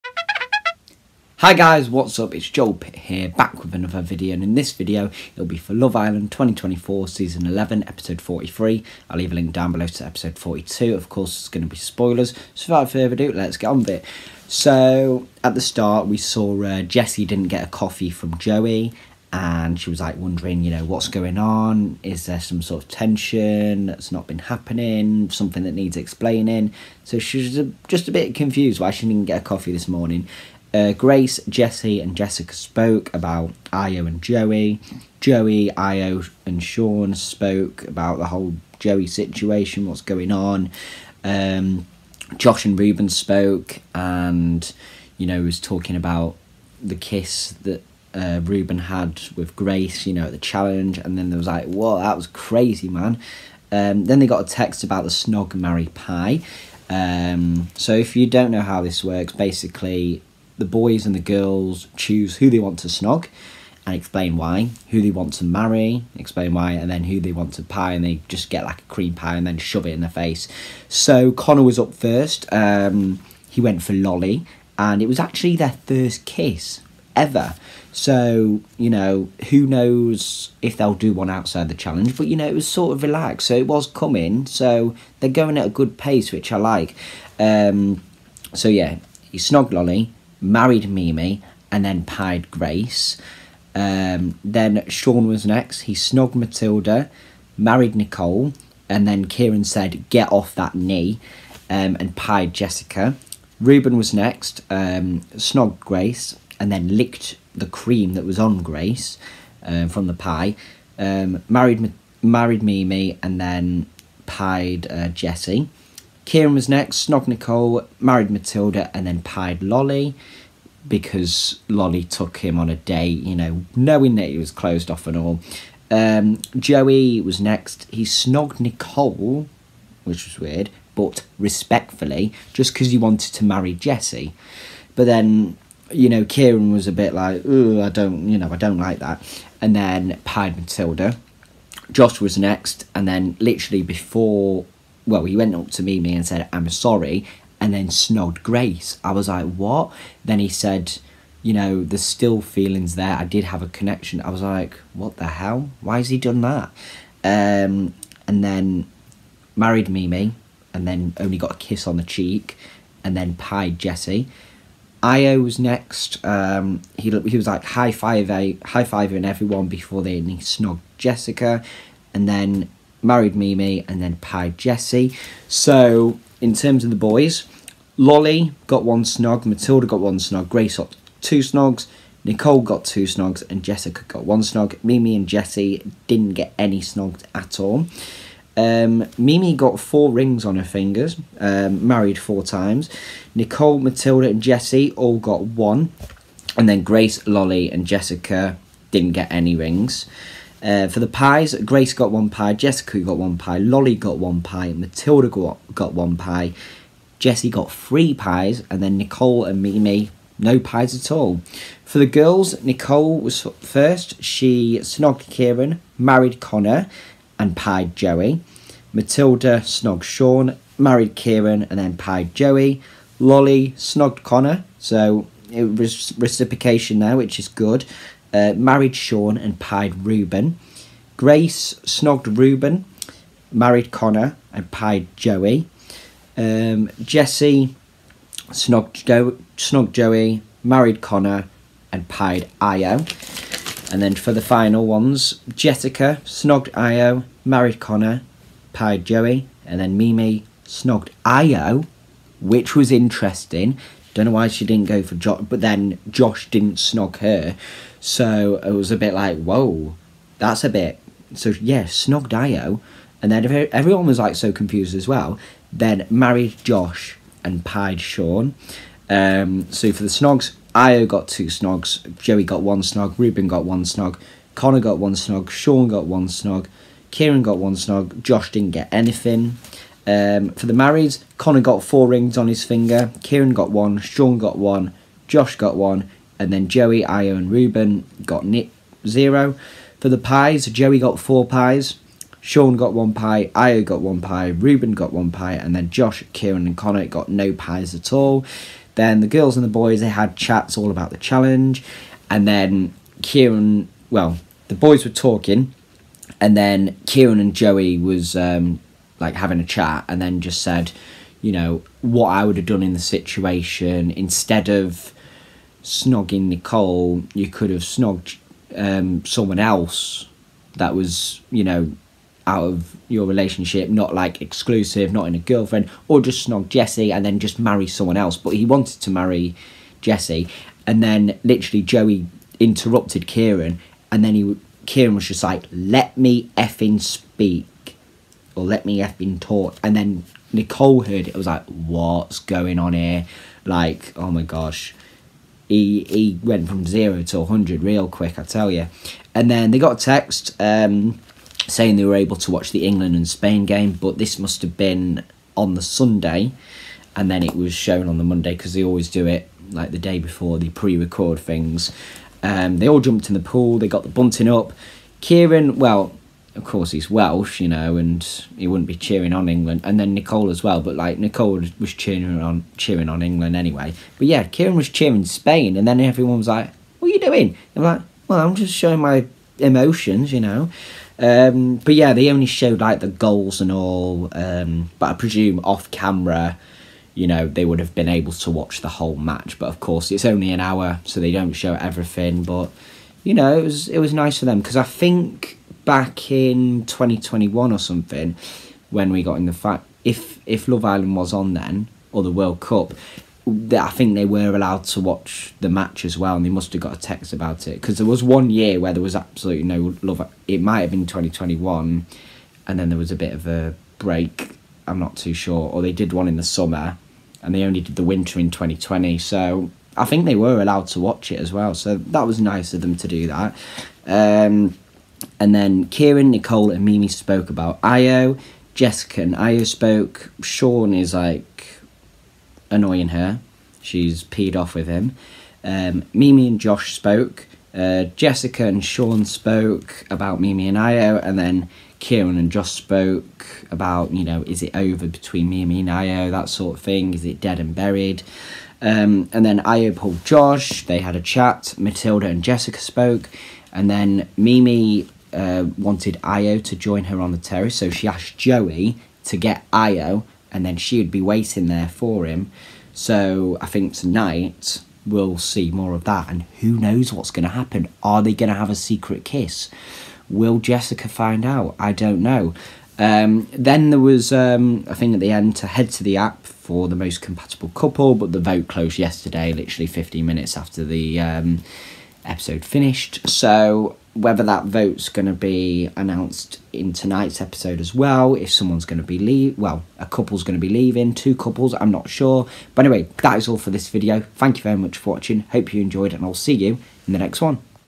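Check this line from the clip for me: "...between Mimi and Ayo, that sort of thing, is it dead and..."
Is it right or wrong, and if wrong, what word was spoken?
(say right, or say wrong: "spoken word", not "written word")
right.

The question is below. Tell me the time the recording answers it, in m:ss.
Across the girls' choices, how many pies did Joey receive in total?
4:50.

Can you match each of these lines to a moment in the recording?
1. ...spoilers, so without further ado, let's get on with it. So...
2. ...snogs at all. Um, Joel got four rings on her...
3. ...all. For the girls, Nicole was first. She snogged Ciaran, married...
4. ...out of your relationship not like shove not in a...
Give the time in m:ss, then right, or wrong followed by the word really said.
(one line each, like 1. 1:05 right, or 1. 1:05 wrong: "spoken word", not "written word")
1. 0:11 right
2. 3:06 wrong: "Mimi", not "Joel"
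3. 3:31 right
4. 5:22 wrong: "exclusive", not "shove".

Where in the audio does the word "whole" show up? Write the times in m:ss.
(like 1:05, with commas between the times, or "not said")
0:38, 6:28.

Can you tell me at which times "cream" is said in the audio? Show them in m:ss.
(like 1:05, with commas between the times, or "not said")
1:08, 1:47.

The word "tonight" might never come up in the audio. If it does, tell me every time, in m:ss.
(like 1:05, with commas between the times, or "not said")
7:43, 8:06.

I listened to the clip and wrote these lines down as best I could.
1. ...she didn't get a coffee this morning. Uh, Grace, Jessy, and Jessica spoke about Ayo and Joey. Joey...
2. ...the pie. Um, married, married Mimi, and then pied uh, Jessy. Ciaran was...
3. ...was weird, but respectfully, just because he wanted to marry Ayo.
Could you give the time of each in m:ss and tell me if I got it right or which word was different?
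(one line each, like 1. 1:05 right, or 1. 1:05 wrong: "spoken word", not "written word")
1. 0:28 right
2. 1:50 right
3. 2:10 wrong: "Jessy", not "Ayo".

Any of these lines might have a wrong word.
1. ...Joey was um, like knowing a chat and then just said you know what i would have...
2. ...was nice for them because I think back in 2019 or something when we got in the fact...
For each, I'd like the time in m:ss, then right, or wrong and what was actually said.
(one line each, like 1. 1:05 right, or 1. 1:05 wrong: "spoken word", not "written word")
1. 5:07 wrong: "having", not "knowing"
2. 6:33 wrong: "2021", not "2019".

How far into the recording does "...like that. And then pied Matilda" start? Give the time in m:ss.
2:18.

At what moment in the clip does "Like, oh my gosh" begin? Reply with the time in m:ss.
5:43.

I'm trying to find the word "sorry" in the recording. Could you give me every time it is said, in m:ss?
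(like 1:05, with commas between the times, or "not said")
2:26.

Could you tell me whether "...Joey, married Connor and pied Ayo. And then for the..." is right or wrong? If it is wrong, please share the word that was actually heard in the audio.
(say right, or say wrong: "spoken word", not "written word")
right.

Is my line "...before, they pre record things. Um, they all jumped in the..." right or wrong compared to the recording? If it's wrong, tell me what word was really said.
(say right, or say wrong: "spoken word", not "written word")
right.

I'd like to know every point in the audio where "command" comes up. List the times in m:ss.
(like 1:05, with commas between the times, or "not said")
not said.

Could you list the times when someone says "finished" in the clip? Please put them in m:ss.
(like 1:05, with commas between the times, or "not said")
8:02.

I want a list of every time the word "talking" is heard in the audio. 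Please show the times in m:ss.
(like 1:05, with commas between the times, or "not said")
0:45, 5:05.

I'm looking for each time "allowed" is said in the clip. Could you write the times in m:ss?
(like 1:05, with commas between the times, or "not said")
6:44, 7:00.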